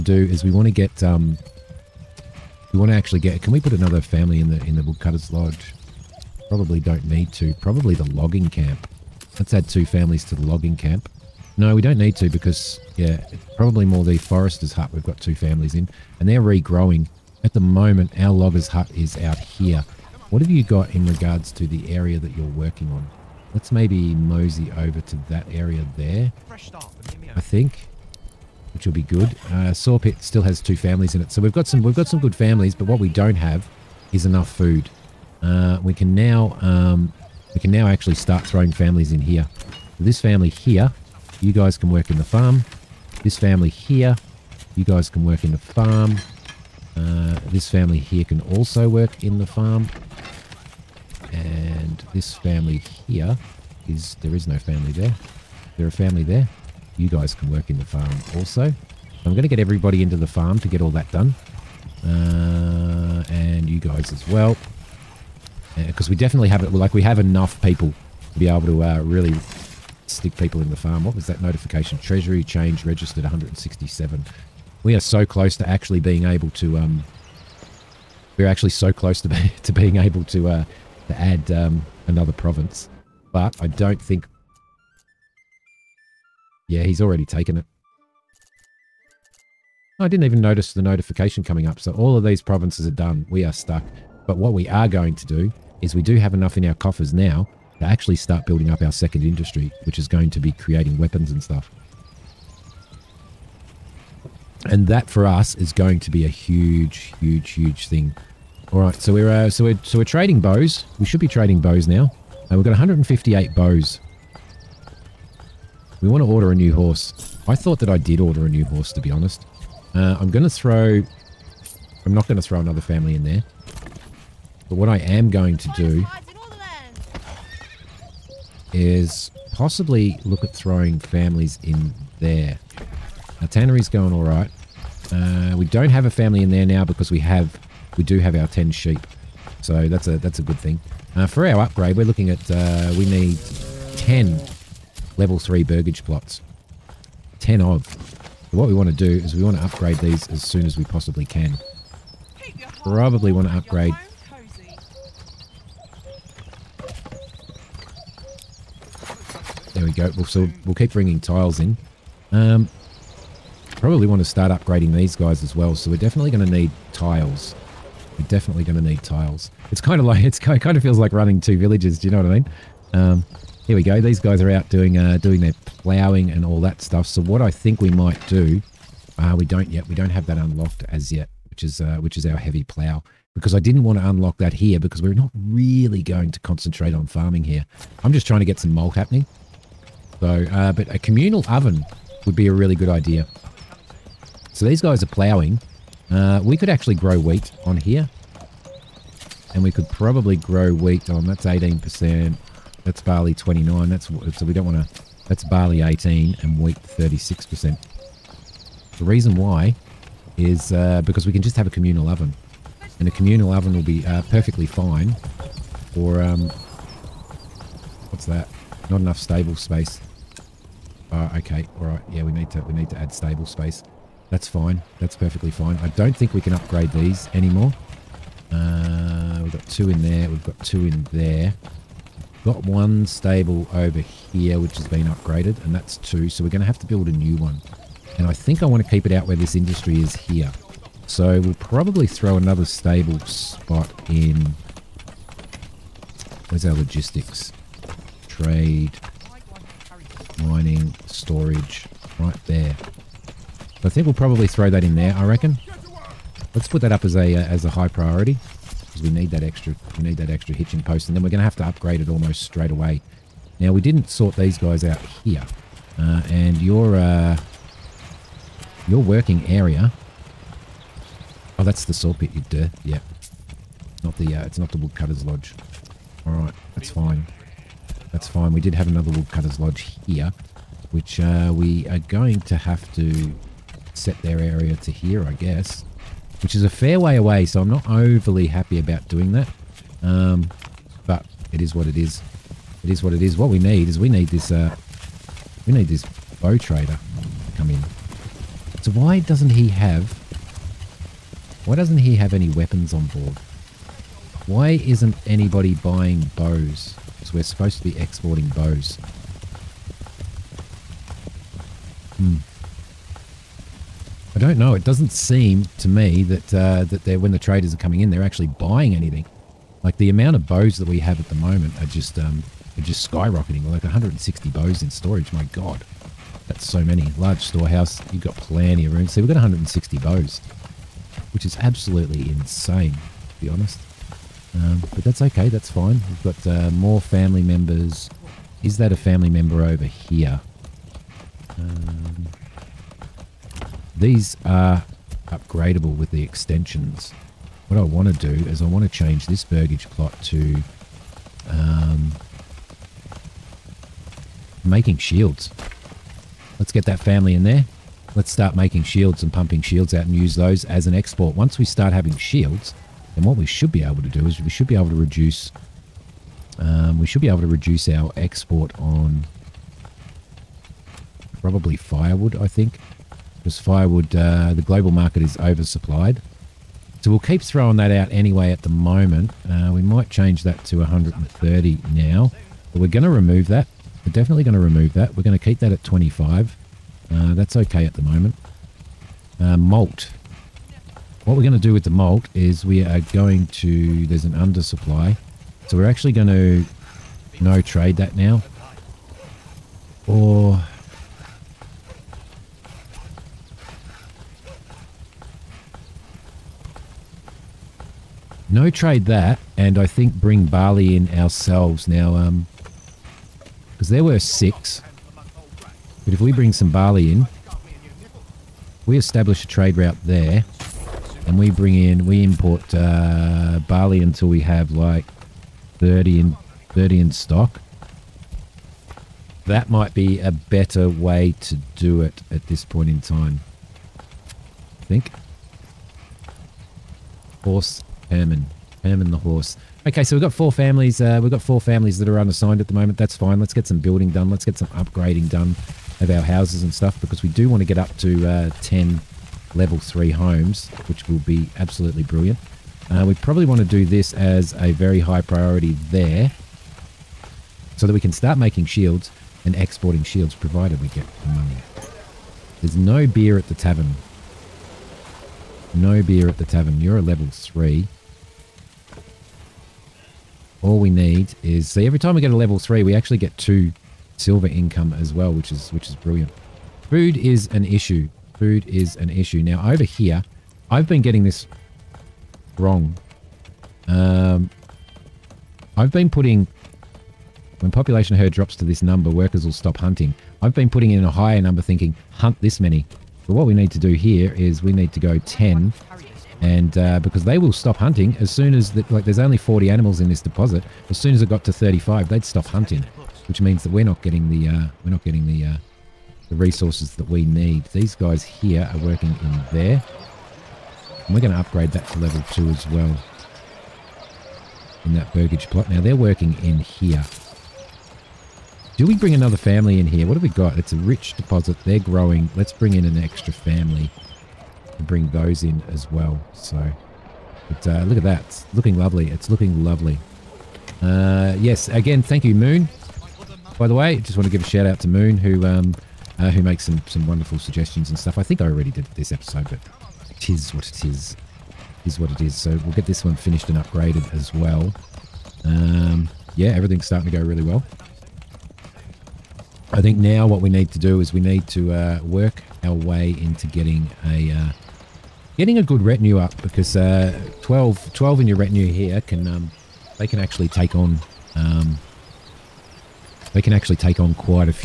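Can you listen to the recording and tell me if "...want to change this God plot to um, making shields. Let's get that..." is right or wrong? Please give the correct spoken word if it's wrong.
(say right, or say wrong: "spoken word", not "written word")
wrong: "Burgage", not "God".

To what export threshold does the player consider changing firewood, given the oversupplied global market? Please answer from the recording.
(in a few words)
130.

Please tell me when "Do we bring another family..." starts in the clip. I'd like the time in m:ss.
8:38.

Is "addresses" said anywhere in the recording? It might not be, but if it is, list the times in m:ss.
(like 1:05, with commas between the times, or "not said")
not said.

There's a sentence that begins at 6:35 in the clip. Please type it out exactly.
So we're actually going to no trade that now.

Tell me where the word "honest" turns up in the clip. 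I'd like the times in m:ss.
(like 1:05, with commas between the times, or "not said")
1:59, 5:33.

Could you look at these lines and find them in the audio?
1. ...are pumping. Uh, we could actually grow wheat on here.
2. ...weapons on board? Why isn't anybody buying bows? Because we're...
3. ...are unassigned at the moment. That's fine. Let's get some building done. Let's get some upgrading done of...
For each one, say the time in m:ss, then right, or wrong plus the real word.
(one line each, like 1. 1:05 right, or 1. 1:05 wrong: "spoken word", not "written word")
1. 3:15 wrong: "ploughing", not "pumping"
2. 5:02 right
3. 7:22 right.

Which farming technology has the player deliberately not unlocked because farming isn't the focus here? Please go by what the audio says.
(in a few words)
Heavy plow.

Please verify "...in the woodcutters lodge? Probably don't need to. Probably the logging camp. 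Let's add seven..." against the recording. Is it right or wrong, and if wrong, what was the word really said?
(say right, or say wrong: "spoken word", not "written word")
wrong: "two", not "seven".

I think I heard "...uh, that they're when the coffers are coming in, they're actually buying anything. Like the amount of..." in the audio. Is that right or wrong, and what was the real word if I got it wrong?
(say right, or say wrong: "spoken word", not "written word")
wrong: "traders", not "coffers".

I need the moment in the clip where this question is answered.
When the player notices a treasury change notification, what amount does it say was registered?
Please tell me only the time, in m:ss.
1:13.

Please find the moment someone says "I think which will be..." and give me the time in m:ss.
0:27.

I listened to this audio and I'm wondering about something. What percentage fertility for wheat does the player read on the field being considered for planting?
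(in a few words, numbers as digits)
36%.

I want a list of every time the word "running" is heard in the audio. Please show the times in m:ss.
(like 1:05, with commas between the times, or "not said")
2:51.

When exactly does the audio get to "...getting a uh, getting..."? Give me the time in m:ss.
9:13.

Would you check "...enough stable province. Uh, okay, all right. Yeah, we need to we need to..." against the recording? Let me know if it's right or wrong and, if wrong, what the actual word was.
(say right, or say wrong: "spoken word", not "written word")
wrong: "space", not "province".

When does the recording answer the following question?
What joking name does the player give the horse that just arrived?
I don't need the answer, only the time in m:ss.
7:18.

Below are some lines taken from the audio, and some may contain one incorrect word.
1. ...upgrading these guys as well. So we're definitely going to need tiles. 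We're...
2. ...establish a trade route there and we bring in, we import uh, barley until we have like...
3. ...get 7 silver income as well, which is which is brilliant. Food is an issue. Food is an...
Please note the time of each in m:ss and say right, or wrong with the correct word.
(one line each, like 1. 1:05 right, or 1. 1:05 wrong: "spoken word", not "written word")
1. 2:44 right
2. 6:58 right
3. 7:53 wrong: "2", not "7".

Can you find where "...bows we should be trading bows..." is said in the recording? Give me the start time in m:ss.
1:50.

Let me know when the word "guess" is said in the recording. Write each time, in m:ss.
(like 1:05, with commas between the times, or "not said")
4:45.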